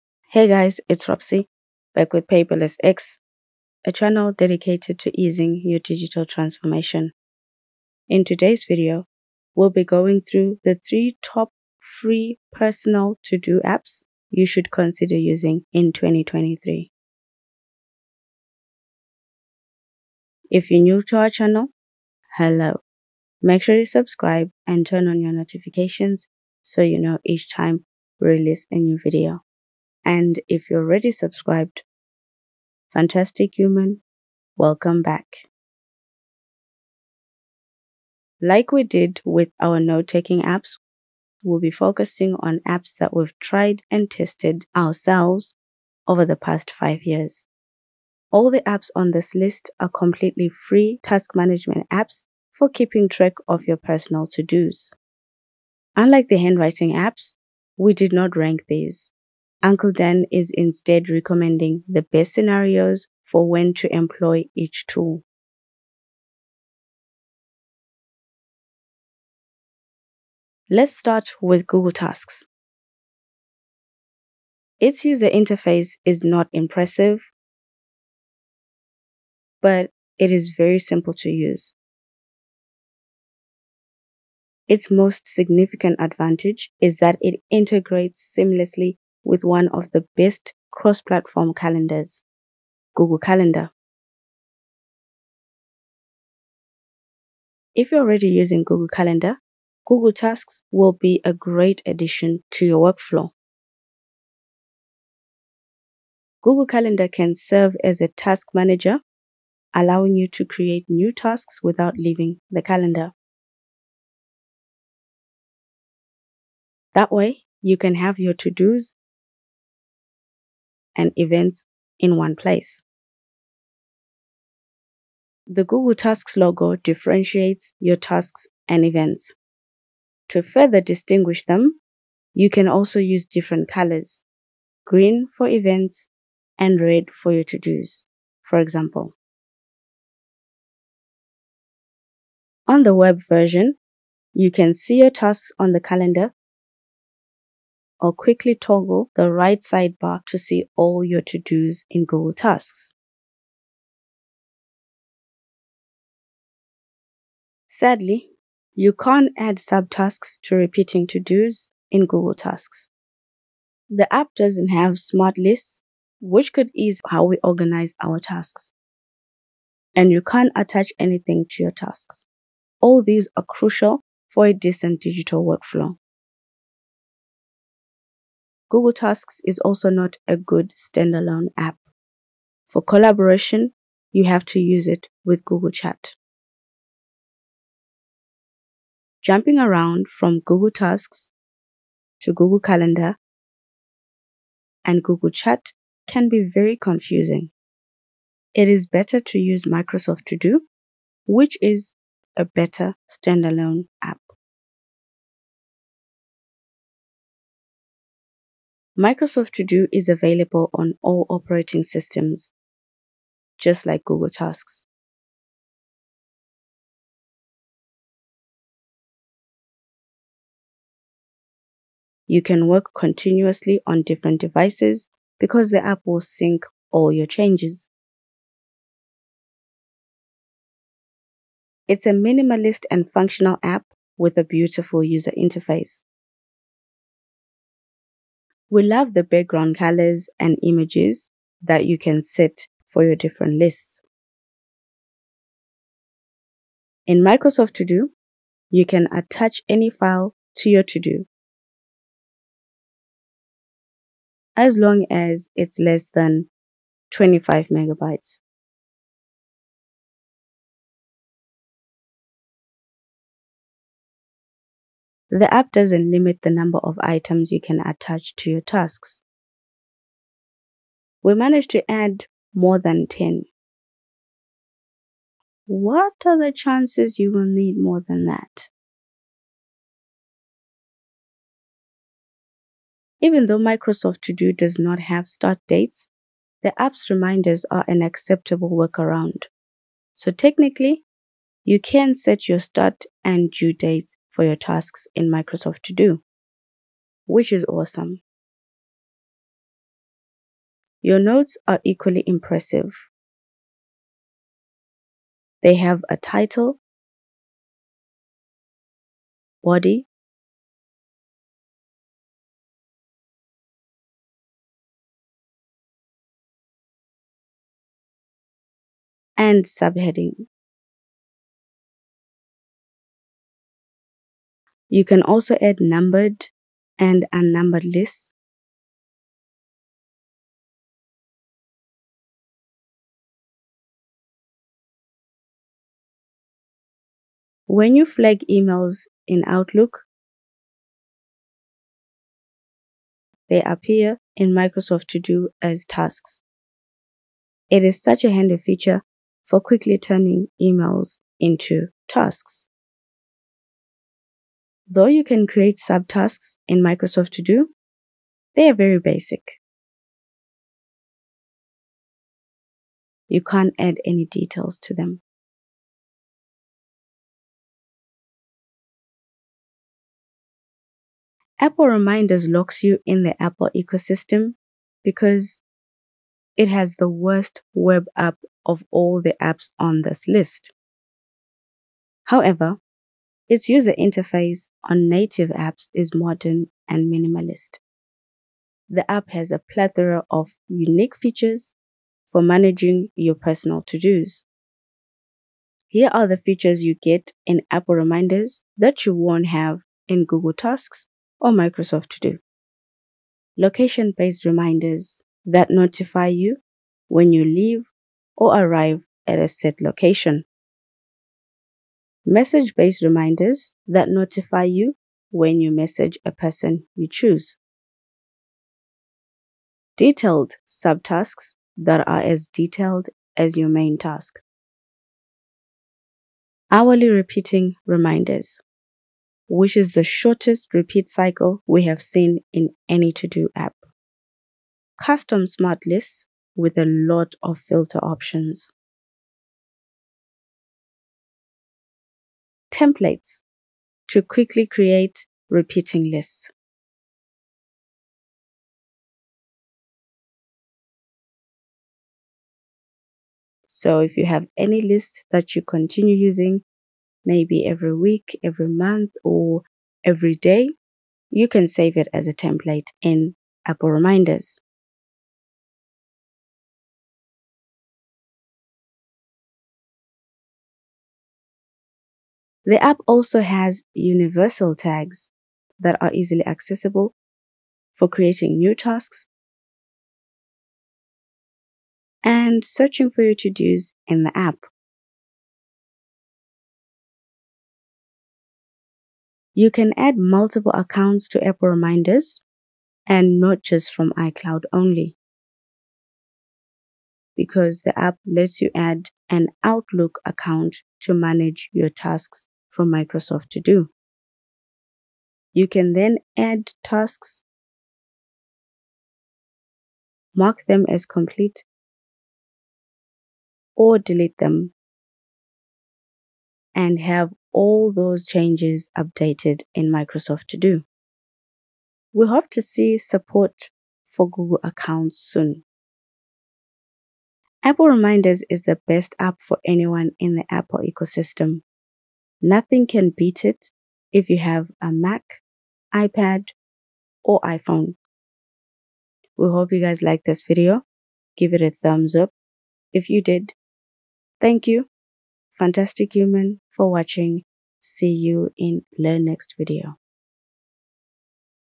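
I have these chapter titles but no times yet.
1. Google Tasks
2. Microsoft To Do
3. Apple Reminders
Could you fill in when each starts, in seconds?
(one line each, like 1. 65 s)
1. 68 s
2. 206 s
3. 369 s.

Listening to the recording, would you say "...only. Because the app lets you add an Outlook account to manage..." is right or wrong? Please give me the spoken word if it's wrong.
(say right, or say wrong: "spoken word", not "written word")
right.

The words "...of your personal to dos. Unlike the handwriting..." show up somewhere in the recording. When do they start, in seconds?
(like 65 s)
53 s.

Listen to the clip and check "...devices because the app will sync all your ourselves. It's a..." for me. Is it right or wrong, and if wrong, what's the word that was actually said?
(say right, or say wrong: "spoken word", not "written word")
wrong: "changes", not "ourselves".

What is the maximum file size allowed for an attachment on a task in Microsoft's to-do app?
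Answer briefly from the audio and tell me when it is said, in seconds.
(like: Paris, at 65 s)
25 megabytes, at 257 s.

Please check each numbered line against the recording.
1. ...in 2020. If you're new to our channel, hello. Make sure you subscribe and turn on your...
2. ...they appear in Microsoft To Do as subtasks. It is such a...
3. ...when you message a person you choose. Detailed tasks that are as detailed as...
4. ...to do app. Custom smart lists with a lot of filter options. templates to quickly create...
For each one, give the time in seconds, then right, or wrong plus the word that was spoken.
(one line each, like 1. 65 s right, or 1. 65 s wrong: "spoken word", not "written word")
1. 15 s wrong: "2023", not "2020"
2. 343 s wrong: "tasks", not "subtasks"
3. 415 s wrong: "subtasks", not "tasks"
4. 433 s right.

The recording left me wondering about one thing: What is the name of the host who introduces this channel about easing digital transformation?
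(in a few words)
Ropsy.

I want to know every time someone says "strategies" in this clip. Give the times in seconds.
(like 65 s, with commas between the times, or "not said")
not said.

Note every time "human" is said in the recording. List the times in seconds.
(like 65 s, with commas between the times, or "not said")
33 s, 546 s.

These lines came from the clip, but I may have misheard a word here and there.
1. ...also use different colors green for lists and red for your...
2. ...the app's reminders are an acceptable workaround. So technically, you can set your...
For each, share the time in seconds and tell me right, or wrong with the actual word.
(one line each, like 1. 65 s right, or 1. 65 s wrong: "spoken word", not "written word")
1. 132 s wrong: "events", not "lists"
2. 286 s right.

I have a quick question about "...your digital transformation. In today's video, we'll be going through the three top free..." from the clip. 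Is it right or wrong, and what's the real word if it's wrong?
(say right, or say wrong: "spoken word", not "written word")
right.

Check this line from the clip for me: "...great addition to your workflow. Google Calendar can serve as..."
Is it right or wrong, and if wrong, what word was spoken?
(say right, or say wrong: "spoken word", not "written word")
right.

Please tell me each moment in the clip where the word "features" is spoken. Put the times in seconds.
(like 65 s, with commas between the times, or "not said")
348 s, 391 s, 396 s.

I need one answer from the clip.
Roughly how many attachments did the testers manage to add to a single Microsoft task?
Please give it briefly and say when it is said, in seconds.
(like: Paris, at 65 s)
More than 10, at 272 s.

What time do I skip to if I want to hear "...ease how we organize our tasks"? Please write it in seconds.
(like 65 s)
166 s.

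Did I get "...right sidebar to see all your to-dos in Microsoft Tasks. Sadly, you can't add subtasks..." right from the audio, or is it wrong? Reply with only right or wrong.
wrong.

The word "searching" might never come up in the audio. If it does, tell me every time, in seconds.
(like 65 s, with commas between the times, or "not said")
482 s.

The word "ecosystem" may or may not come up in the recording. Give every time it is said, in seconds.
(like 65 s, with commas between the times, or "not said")
373 s, 530 s.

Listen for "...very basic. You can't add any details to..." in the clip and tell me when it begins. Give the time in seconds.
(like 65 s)
358 s.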